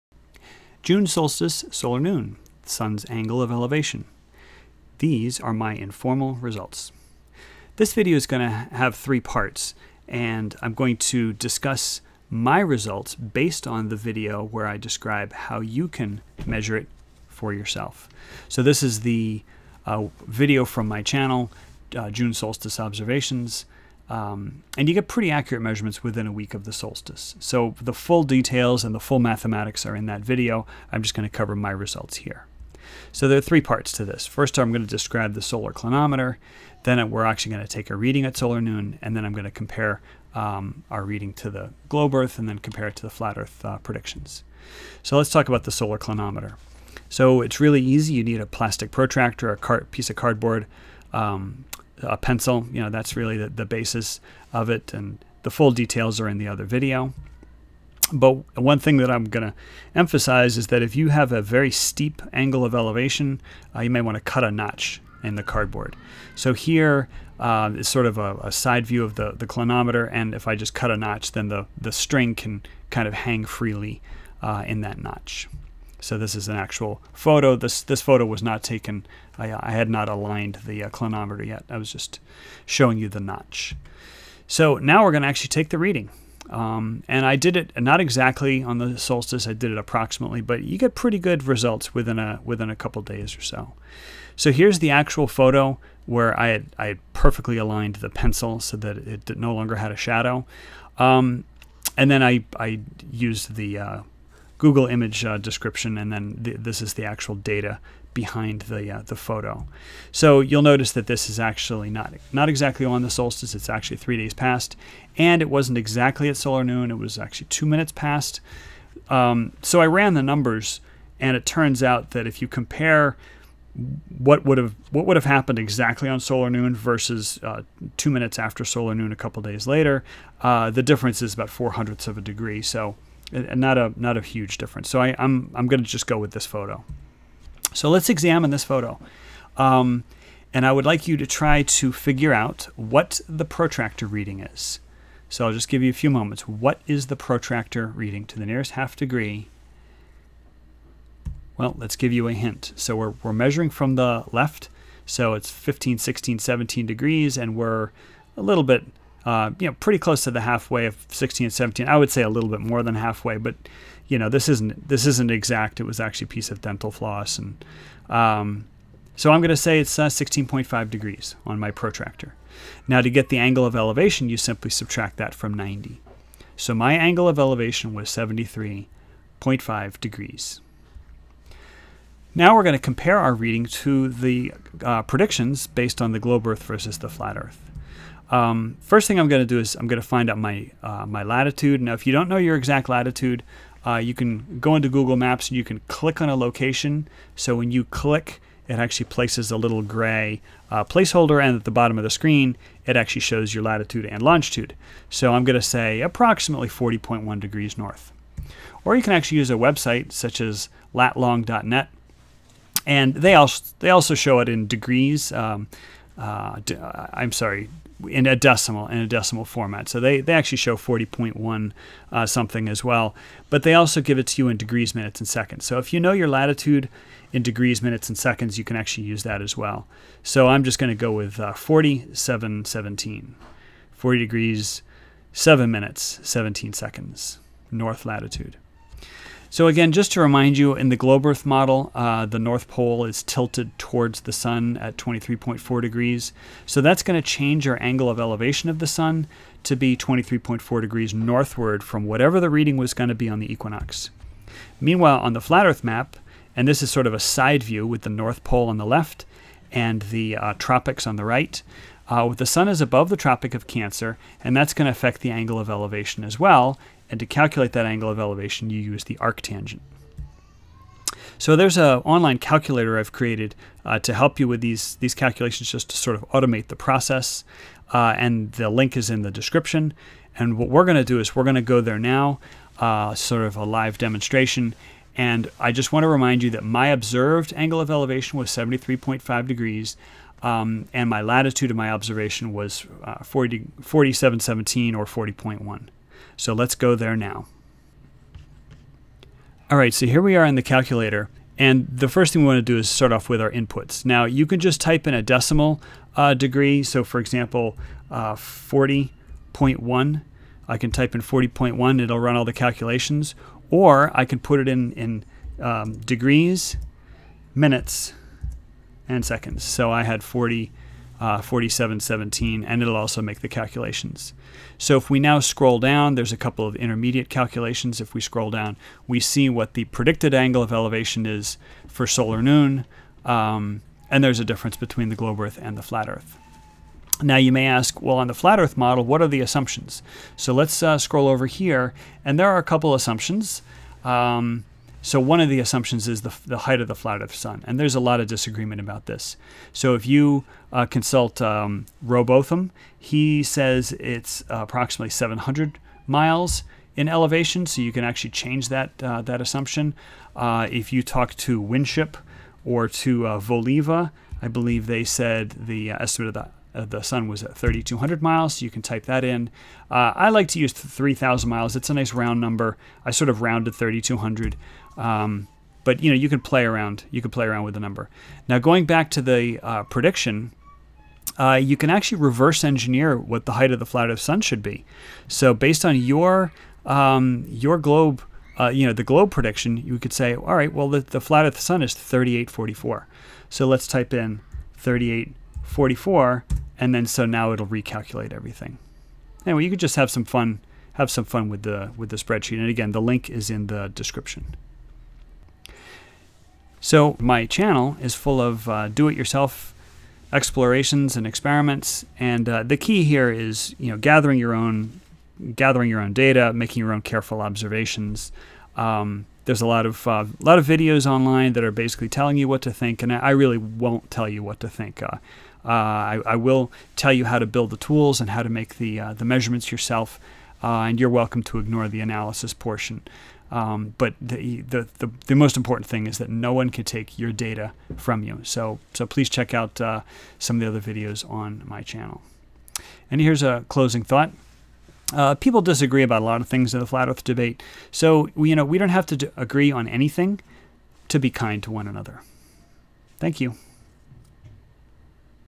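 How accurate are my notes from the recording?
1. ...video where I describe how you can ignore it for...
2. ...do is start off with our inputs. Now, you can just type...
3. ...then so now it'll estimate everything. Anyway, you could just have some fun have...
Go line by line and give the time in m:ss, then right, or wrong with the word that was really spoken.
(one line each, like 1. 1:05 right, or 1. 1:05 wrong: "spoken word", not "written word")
1. 0:13 wrong: "measure", not "ignore"
2. 5:02 right
3. 6:36 wrong: "recalculate", not "estimate".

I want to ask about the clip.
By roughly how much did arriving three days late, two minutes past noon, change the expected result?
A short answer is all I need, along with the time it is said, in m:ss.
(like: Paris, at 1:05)
four hundredths of a degree, at 2:11.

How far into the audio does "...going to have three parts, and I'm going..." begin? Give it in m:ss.
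0:08.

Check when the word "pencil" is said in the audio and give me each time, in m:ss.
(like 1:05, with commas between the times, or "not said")
0:52, 1:38.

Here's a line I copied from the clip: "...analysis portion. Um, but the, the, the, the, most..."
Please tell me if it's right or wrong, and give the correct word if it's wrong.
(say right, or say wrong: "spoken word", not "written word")
right.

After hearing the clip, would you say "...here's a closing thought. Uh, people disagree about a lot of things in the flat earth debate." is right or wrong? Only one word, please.
right.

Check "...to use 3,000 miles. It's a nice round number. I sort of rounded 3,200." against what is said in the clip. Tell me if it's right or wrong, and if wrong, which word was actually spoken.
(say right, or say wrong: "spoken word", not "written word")
right.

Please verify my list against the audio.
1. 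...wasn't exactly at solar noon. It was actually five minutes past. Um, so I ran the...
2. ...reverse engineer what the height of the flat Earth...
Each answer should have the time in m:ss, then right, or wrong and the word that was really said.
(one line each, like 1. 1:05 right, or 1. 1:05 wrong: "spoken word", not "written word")
1. 1:55 wrong: "two", not "five"
2. 6:22 right.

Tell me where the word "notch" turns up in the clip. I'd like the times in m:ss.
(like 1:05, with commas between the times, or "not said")
1:04, 1:10, 1:15, 1:23.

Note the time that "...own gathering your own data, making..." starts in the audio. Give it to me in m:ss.
6:54.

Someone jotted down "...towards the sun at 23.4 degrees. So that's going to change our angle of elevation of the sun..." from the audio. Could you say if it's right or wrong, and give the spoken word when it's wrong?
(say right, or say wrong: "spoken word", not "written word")
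right.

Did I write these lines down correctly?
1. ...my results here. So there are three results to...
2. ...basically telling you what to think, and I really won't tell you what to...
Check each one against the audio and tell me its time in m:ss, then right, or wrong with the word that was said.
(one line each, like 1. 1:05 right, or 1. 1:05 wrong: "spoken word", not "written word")
1. 0:31 wrong: "parts", not "results"
2. 7:01 right.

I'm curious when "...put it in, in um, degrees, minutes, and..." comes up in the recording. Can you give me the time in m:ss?
5:14.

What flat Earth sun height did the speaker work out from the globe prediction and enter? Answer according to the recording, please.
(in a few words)
3844.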